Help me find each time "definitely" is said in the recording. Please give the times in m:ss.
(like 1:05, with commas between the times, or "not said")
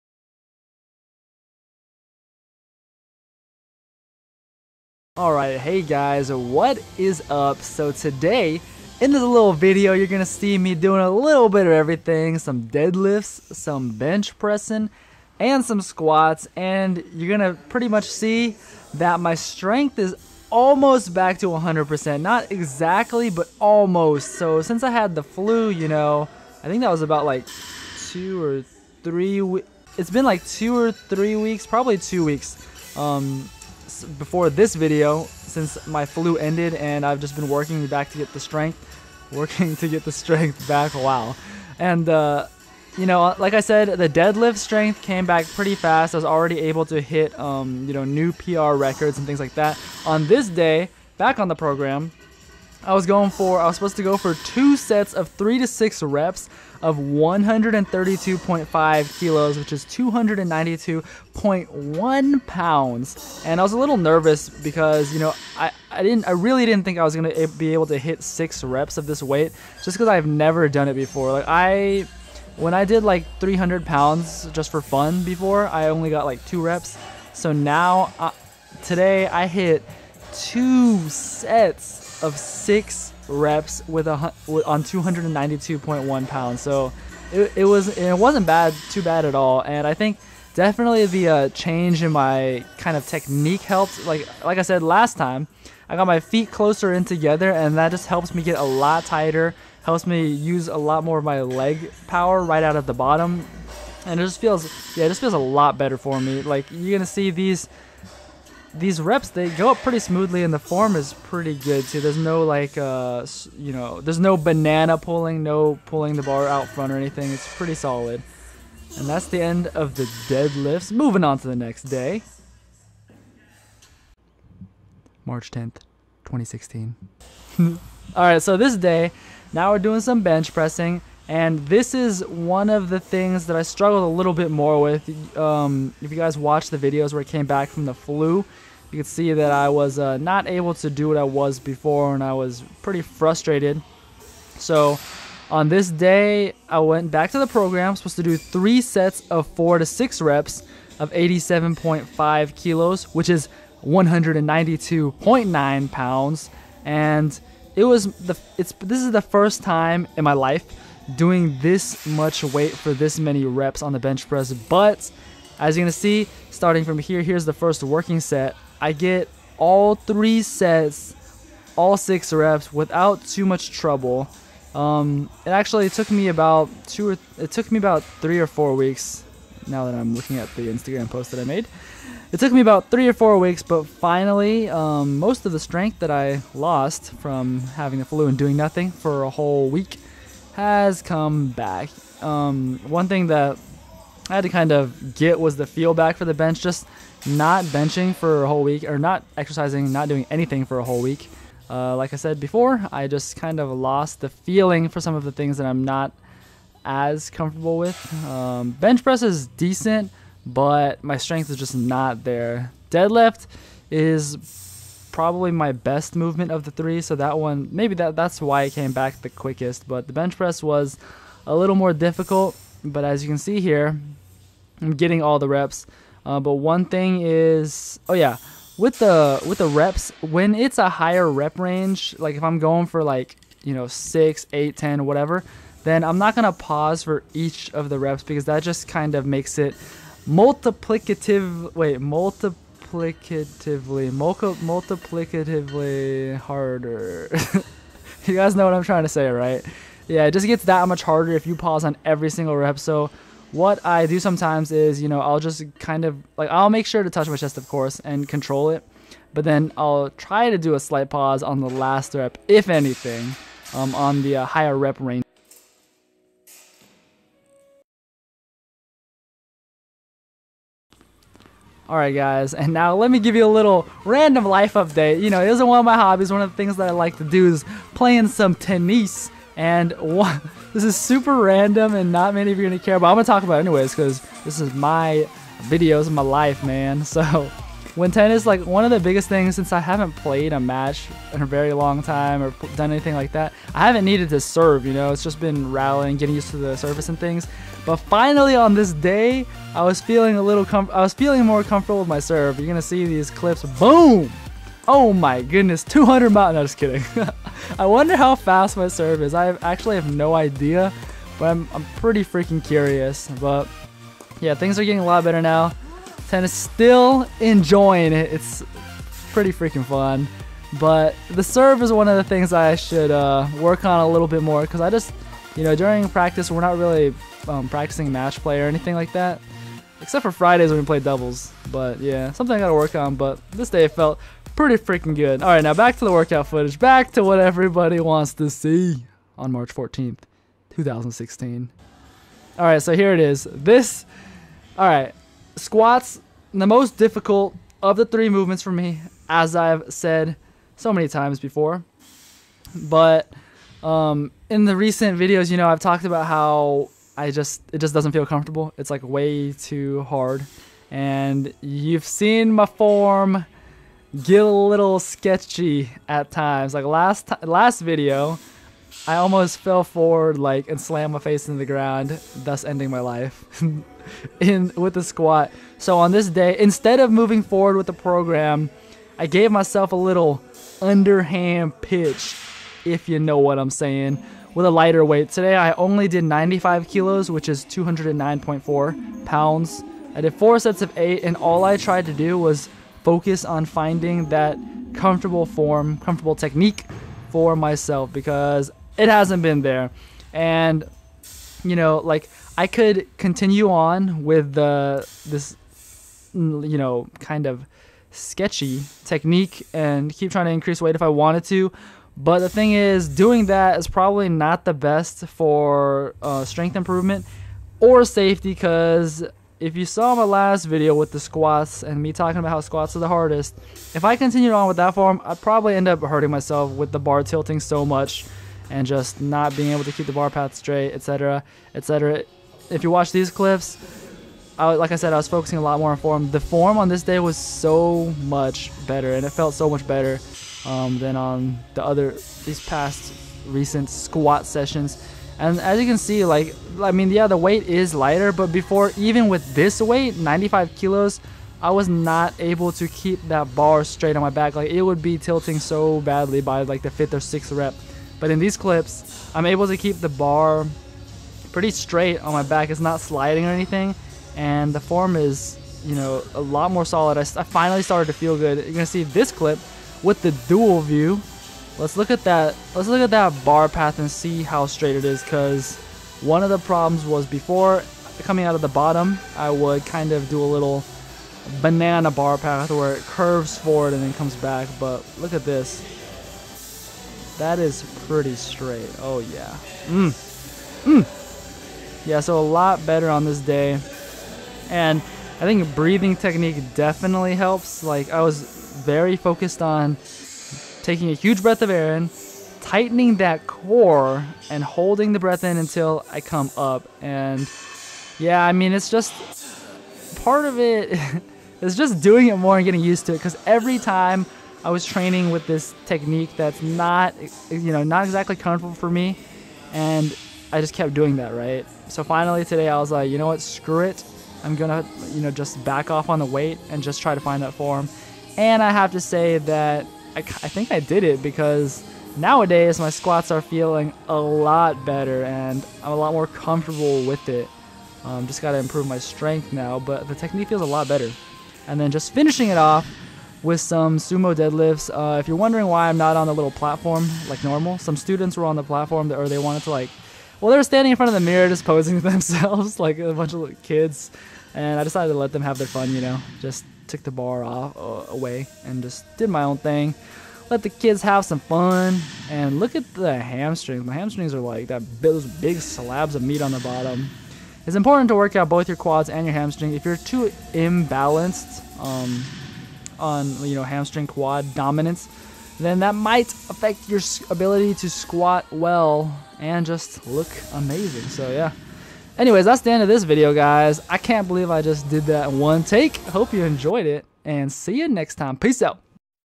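1:30, 8:16.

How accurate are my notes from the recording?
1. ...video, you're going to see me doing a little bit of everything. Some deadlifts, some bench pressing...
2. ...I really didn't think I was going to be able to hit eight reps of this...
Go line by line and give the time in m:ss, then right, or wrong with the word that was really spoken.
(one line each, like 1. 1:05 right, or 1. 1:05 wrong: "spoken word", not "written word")
1. 0:09 right
2. 1:06 wrong: "six", not "eight".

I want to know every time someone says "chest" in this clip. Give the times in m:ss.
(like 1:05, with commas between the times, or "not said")
4:17.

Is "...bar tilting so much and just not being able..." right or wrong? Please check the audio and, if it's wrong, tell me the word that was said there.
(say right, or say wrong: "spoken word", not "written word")
right.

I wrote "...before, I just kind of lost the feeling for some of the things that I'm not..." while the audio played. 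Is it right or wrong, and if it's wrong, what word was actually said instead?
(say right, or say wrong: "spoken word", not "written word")
right.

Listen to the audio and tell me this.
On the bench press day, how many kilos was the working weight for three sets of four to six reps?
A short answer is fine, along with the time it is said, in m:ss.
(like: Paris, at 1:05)
87.5 kilos, at 2:31.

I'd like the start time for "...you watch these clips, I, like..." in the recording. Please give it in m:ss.
7:12.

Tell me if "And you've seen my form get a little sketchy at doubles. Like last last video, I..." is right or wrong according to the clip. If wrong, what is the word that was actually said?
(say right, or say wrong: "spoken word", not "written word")
wrong: "times", not "doubles".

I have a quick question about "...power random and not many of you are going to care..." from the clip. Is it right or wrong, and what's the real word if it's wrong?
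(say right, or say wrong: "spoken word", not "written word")
wrong: "super", not "power".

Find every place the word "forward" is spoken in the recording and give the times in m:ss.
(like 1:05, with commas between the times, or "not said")
6:09, 6:17, 8:03.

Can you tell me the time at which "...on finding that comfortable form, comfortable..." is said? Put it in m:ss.
6:33.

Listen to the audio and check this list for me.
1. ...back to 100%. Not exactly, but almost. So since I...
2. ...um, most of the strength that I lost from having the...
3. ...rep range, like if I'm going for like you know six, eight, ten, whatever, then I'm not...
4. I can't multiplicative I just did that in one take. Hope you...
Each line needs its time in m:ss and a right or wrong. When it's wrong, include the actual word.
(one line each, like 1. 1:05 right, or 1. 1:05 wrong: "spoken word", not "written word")
1. 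0:21 right
2. 3:04 right
3. 3:51 right
4. 9:43 wrong: "believe", not "multiplicative".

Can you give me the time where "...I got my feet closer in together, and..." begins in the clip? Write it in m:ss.
1:35.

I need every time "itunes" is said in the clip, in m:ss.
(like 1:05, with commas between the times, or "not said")
not said.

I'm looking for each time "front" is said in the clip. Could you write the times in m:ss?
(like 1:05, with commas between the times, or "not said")
1:56, 9:10.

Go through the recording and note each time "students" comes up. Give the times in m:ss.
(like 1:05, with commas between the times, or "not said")
9:07.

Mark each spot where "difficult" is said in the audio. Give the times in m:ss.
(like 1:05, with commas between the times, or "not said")
3:41, 5:46.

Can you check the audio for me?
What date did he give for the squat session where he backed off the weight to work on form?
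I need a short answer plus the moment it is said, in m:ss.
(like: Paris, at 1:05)
March 14th, 2016, at 5:39.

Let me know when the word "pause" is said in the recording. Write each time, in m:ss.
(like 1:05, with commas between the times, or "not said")
3:56, 4:11, 4:21.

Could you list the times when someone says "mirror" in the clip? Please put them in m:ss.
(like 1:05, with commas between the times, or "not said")
9:11.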